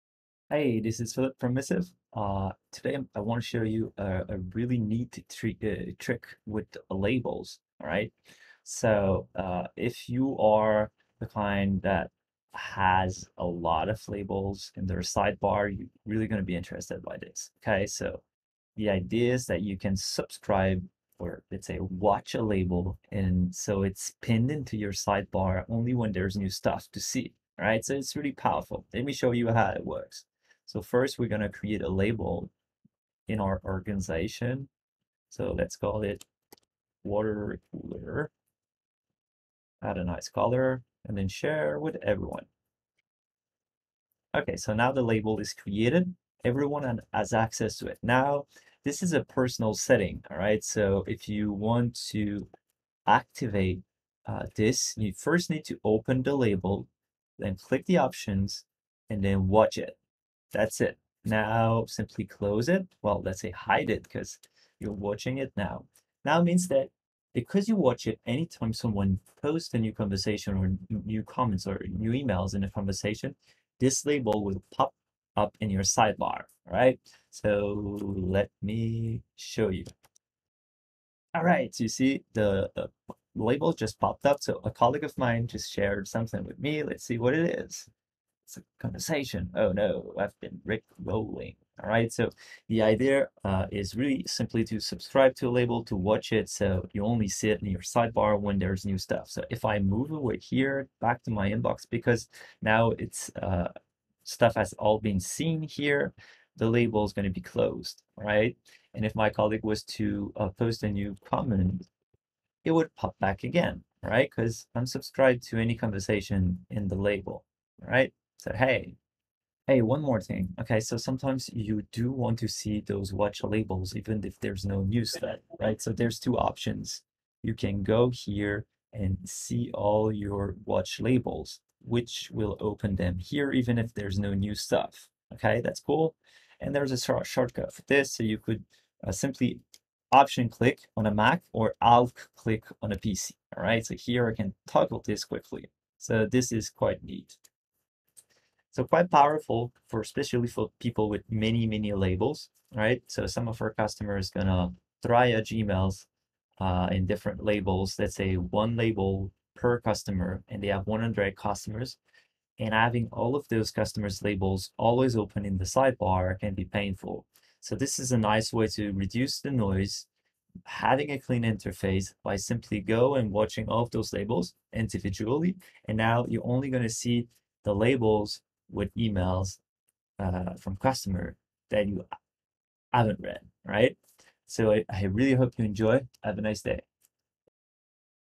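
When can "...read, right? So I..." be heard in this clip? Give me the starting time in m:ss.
3:03.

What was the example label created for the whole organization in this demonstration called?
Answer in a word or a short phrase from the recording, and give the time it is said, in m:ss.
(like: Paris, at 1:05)
Water cooler, at 0:37.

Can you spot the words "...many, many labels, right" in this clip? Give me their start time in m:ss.
2:31.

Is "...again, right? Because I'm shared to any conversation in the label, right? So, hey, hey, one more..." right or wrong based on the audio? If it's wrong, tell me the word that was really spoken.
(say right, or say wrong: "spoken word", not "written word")
wrong: "subscribed", not "shared".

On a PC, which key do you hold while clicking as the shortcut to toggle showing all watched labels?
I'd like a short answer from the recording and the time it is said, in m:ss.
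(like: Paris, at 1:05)
Alt, at 2:21.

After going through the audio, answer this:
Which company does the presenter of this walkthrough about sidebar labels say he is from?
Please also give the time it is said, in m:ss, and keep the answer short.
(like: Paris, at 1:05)
Missive, at 0:01.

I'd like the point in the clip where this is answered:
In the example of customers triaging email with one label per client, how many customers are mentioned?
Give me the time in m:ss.
2:40.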